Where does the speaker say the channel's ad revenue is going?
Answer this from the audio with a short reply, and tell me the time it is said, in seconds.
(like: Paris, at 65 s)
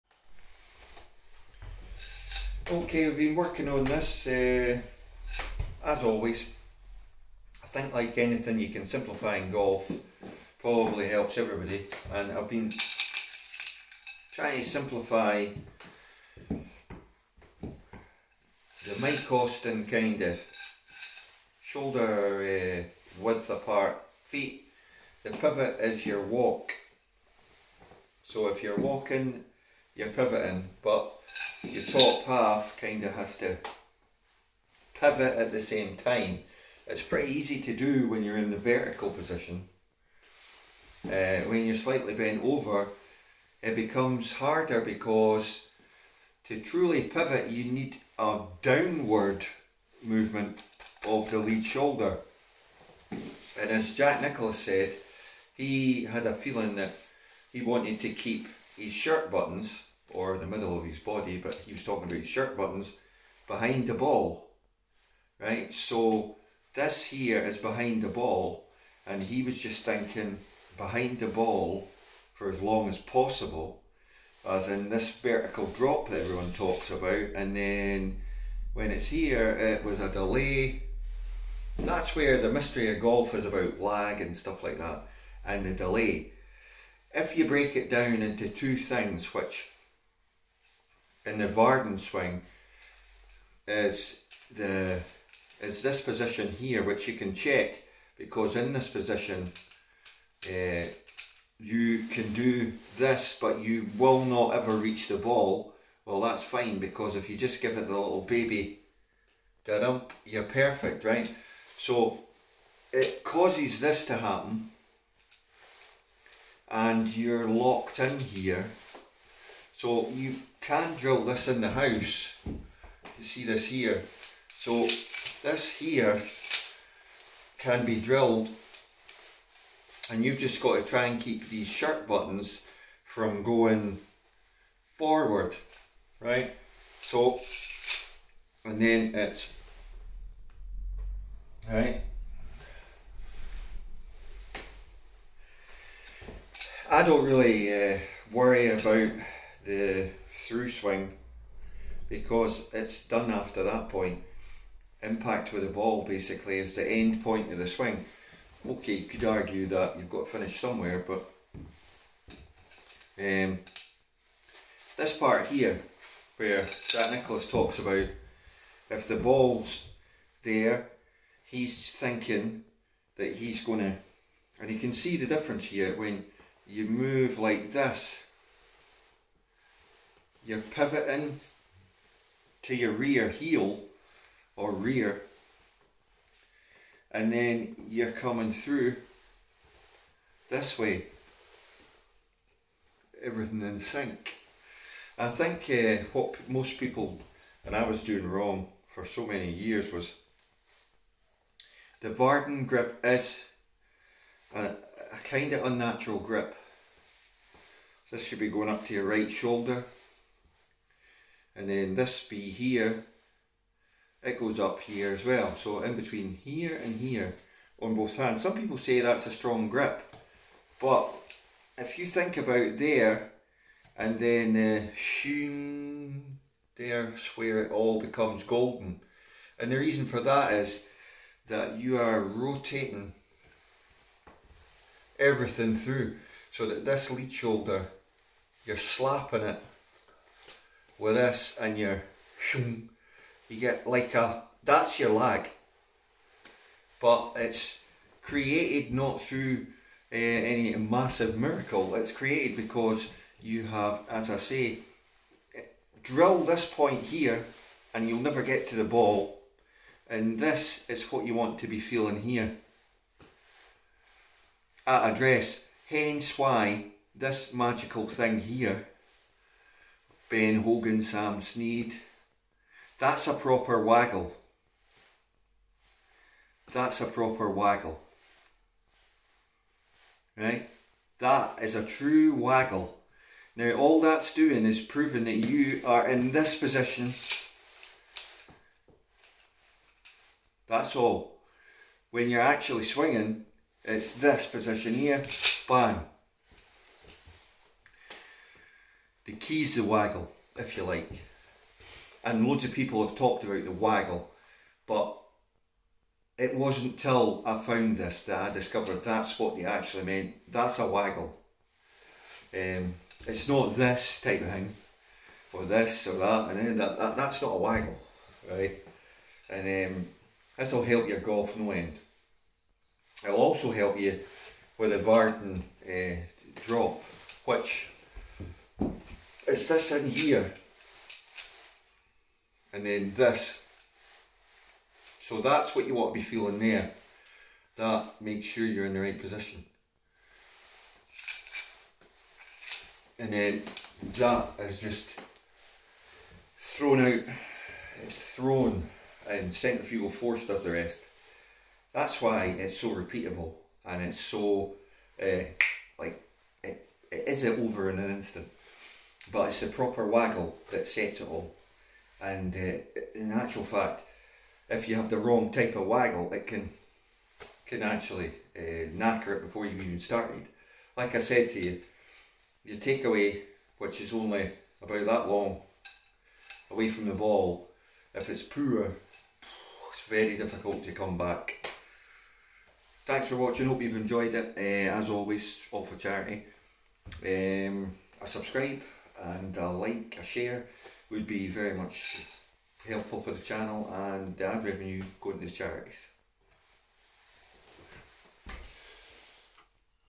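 charities, at 395 s.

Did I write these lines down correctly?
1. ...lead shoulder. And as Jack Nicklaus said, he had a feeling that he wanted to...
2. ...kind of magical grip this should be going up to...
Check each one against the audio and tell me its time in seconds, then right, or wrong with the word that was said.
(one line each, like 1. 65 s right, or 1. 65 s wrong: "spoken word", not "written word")
1. 51 s right
2. 205 s wrong: "unnatural", not "magical".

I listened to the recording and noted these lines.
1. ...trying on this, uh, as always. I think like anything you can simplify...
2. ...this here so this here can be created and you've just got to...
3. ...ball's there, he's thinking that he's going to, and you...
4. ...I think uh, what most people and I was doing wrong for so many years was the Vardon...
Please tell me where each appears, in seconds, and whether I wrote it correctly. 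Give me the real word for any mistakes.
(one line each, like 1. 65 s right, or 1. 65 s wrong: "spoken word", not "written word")
1. 3 s wrong: "working", not "trying"
2. 123 s wrong: "drilled", not "created"
3. 169 s right
4. 195 s right.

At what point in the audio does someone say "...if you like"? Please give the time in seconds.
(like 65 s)
300 s.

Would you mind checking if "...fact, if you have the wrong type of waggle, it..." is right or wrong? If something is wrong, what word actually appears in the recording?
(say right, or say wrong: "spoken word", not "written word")
right.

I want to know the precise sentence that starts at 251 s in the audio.
It's created because you have, as I say, drill this point here and you'll never get to the ball.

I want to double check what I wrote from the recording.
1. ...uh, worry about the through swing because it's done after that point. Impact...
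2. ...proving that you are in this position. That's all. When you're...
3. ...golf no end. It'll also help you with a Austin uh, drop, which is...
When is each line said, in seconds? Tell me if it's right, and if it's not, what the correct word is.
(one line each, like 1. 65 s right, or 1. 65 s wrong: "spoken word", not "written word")
1. 147 s right
2. 284 s right
3. 321 s wrong: "Vardon", not "Austin".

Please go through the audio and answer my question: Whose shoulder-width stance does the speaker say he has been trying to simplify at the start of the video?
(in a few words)
Mike Austin.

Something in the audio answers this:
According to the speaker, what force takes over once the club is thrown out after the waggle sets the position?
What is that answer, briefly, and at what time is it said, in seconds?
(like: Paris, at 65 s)
centrifugal force, at 349 s.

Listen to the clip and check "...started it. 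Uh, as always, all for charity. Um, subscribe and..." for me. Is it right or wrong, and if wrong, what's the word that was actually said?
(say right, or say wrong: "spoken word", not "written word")
wrong: "enjoyed", not "started".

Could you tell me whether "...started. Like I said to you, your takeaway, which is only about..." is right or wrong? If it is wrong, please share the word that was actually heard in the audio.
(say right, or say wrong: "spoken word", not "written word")
right.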